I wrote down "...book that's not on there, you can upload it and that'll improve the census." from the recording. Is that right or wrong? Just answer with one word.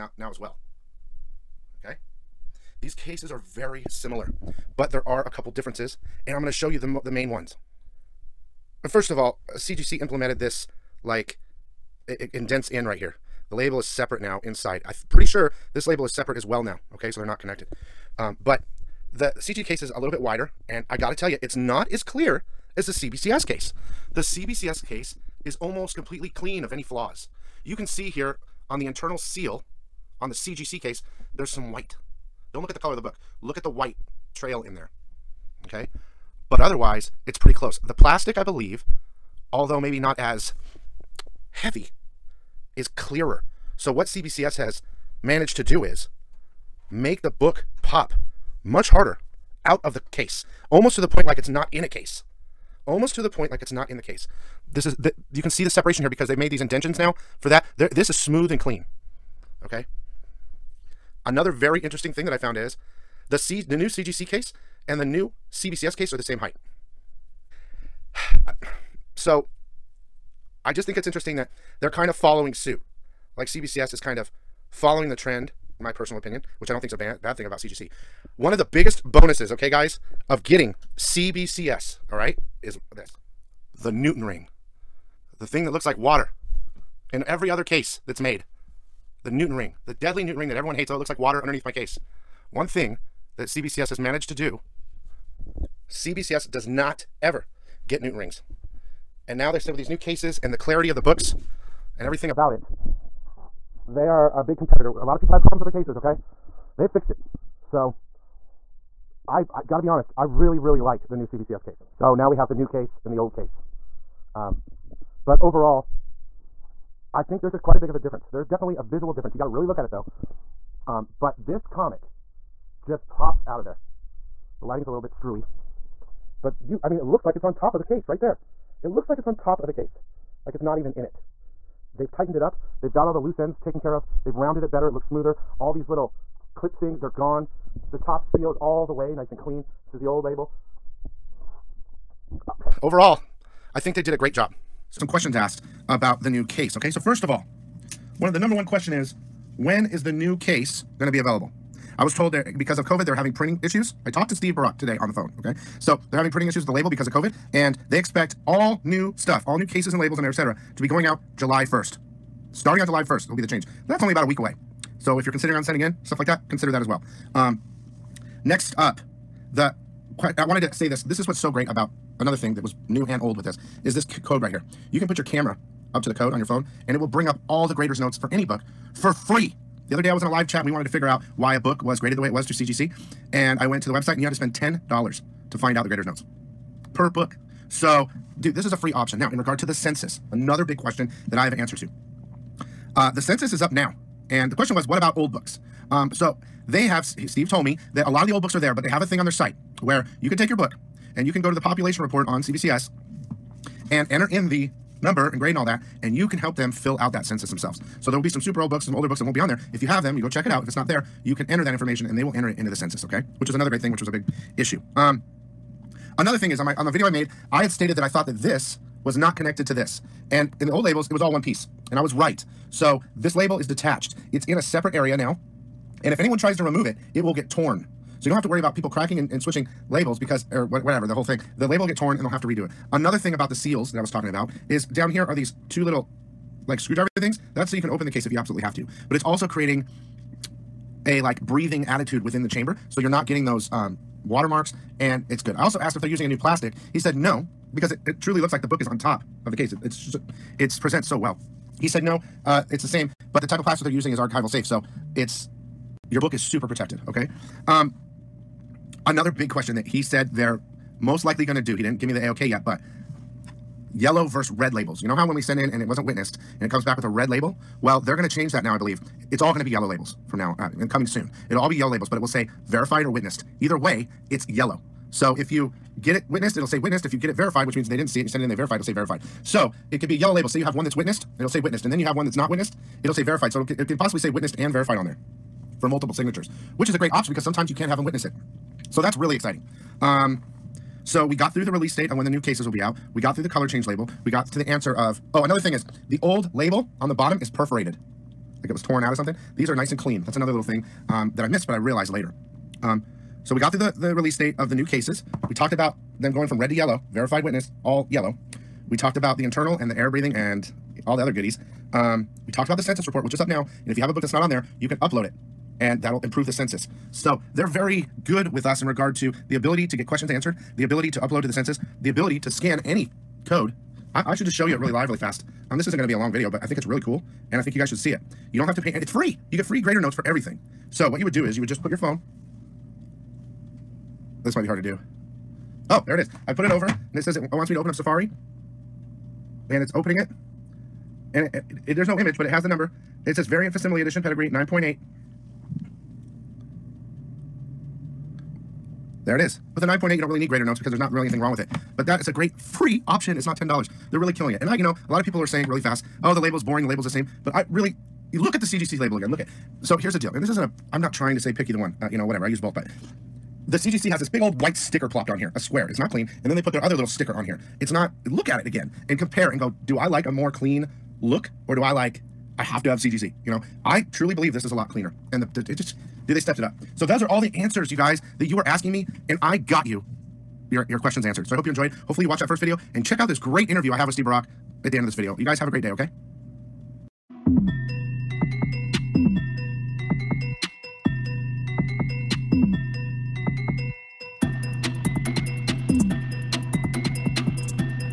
right.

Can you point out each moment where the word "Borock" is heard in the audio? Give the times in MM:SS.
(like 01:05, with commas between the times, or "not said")
02:34, 06:24.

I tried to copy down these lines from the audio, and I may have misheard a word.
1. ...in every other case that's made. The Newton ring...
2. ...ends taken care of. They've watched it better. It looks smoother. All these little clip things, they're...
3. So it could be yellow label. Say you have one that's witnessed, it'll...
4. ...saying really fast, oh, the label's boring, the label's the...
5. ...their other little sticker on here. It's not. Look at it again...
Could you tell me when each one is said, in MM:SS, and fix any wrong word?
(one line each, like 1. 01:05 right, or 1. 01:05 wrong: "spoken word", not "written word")
1. 01:27 right
2. 02:13 wrong: "rounded", not "watched"
3. 04:39 right
4. 05:55 right
5. 06:06 right.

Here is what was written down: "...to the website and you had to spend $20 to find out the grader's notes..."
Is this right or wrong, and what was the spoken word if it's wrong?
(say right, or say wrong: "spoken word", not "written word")
wrong: "10", not "20".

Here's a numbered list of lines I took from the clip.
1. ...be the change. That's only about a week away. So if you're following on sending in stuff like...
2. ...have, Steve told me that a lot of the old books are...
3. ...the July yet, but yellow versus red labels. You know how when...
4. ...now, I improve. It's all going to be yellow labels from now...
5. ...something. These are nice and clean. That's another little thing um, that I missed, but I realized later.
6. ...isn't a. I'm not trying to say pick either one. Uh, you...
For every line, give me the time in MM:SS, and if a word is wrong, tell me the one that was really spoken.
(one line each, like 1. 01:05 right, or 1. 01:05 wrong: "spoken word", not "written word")
1. 02:43 wrong: "considering", not "following"
2. 03:16 right
3. 04:22 wrong: "AOK", not "July"
4. 04:28 wrong: "believe", not "improve"
5. 04:59 right
6. 06:00 right.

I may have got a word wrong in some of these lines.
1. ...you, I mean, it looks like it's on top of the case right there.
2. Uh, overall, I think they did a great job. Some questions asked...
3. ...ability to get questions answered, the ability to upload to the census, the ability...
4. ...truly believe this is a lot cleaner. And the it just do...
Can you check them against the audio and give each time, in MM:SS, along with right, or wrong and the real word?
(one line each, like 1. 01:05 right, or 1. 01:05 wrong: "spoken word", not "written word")
1. 02:06 right
2. 02:22 right
3. 05:19 right
4. 06:14 right.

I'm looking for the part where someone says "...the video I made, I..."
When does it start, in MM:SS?
03:36.